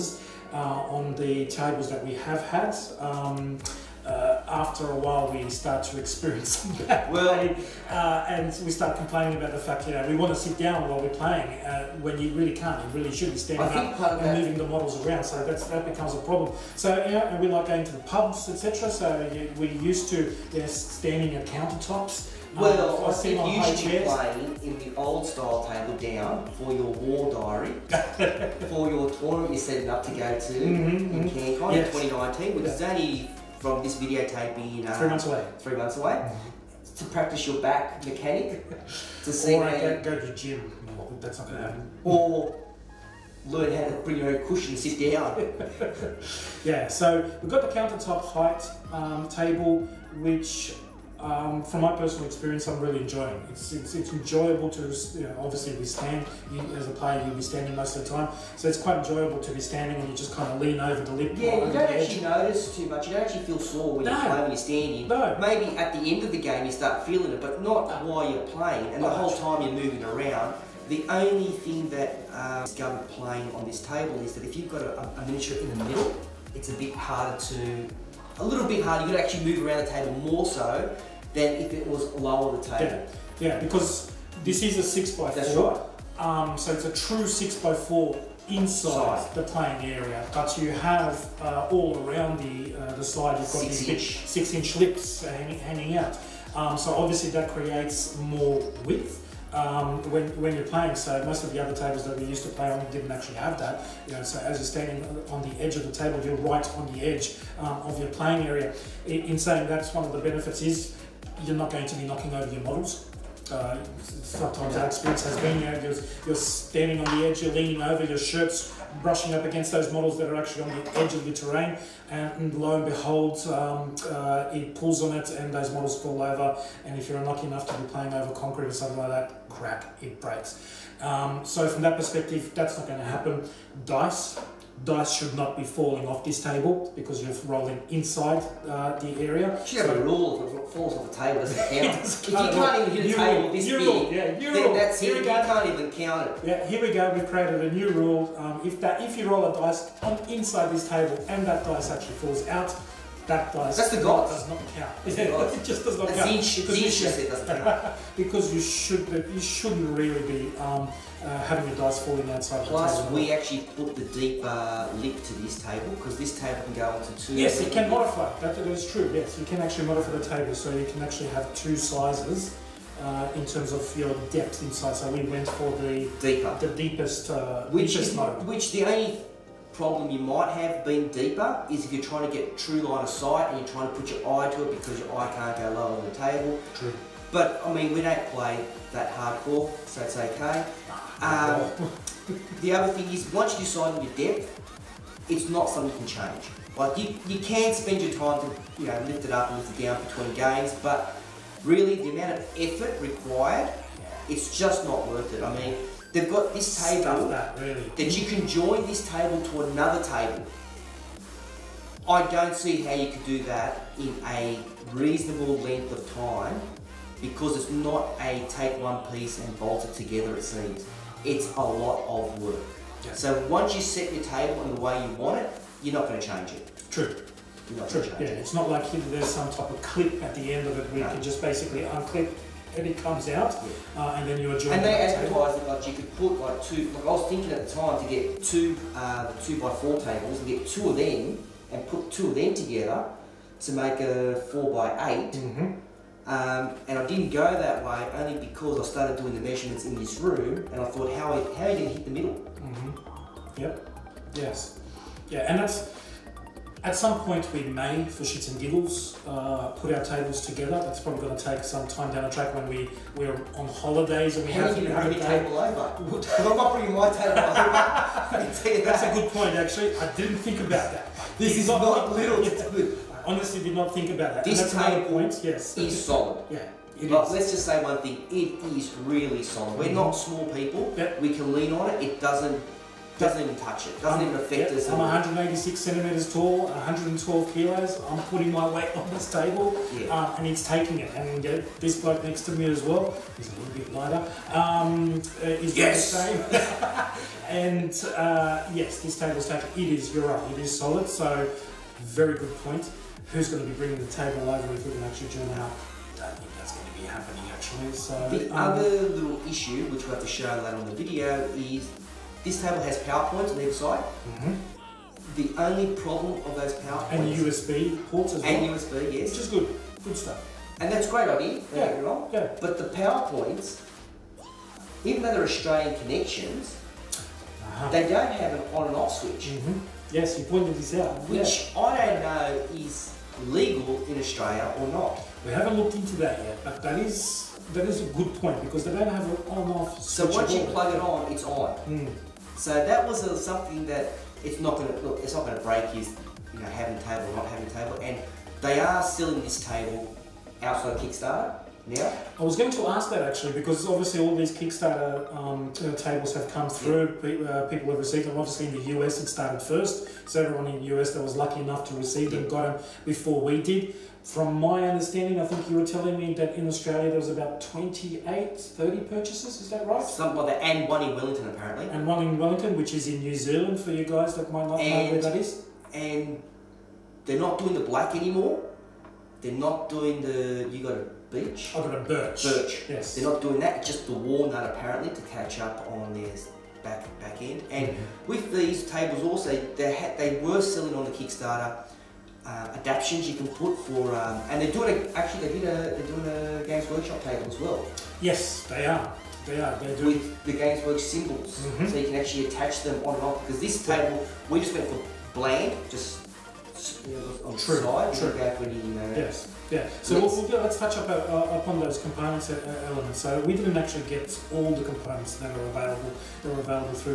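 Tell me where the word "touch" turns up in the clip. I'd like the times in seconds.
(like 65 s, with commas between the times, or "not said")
283 s, 410 s.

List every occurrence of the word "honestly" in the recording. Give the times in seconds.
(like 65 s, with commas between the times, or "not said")
273 s.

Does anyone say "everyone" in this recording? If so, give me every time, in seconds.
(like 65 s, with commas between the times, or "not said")
360 s.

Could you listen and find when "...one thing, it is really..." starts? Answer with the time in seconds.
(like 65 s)
277 s.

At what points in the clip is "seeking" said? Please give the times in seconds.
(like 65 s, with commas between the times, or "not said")
not said.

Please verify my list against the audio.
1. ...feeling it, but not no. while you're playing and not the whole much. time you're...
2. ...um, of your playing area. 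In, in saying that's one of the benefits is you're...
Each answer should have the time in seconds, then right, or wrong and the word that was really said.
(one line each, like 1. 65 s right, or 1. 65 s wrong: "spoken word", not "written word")
1. 67 s right
2. 107 s right.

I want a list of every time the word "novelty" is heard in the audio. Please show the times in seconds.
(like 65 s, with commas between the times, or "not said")
not said.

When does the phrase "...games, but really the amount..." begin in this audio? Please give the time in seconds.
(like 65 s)
200 s.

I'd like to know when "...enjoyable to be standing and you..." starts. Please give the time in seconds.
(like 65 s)
58 s.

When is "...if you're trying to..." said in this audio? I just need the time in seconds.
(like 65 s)
181 s.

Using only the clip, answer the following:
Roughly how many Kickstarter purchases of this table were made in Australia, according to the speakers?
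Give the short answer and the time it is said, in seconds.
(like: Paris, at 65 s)
28 to 30, at 367 s.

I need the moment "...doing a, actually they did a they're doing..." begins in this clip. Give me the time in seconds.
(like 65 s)
394 s.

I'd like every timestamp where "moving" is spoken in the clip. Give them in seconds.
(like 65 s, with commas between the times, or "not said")
14 s, 69 s.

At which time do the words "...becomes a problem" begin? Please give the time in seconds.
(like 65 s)
15 s.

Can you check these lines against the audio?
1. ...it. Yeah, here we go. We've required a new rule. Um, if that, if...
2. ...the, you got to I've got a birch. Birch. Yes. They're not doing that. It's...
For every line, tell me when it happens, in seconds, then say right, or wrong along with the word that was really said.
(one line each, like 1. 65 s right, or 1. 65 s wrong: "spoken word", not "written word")
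1. 146 s wrong: "created", not "required"
2. 380 s right.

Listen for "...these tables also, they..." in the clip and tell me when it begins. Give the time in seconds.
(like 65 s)
388 s.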